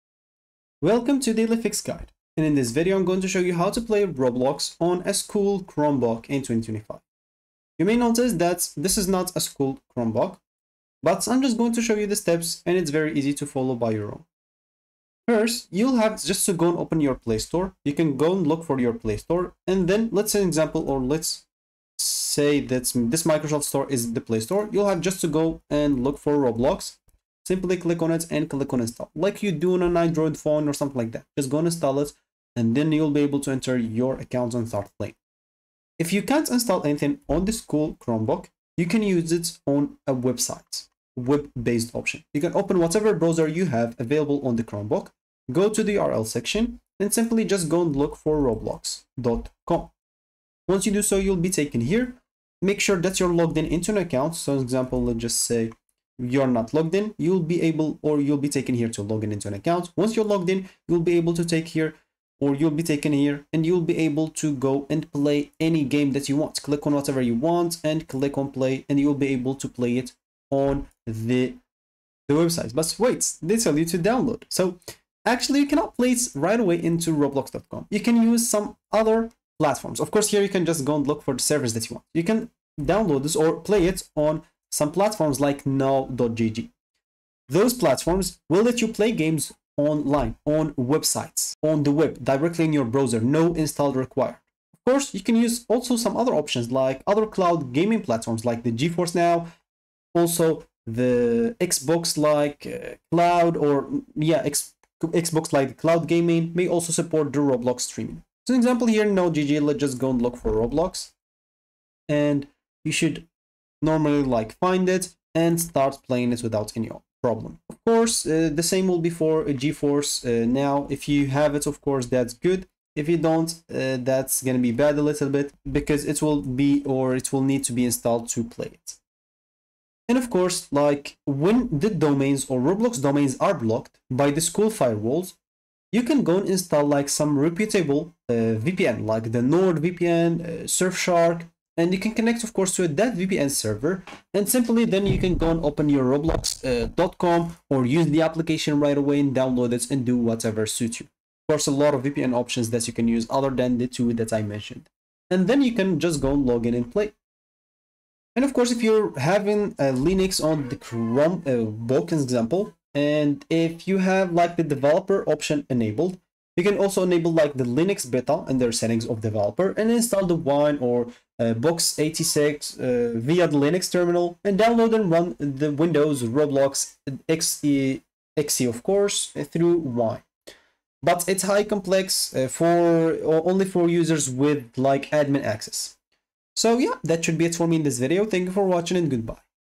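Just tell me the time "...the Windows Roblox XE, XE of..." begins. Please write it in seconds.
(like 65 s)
175 s.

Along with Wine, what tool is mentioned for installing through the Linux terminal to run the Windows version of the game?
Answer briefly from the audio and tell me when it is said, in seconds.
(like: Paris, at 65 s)
Box86, at 171 s.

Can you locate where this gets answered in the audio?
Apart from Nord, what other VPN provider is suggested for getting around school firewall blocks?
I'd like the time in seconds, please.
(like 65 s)
140 s.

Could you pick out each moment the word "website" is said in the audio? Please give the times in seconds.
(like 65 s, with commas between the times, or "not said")
40 s, 72 s, 90 s.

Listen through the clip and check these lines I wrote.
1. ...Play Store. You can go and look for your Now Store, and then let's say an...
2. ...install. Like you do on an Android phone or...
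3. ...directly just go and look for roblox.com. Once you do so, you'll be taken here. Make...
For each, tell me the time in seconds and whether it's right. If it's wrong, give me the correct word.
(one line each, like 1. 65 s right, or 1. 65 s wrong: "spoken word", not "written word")
1. 17 s wrong: "Play", not "Now"
2. 28 s right
3. 47 s wrong: "simply", not "directly".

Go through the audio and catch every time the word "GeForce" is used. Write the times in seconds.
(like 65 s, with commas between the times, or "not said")
98 s, 119 s.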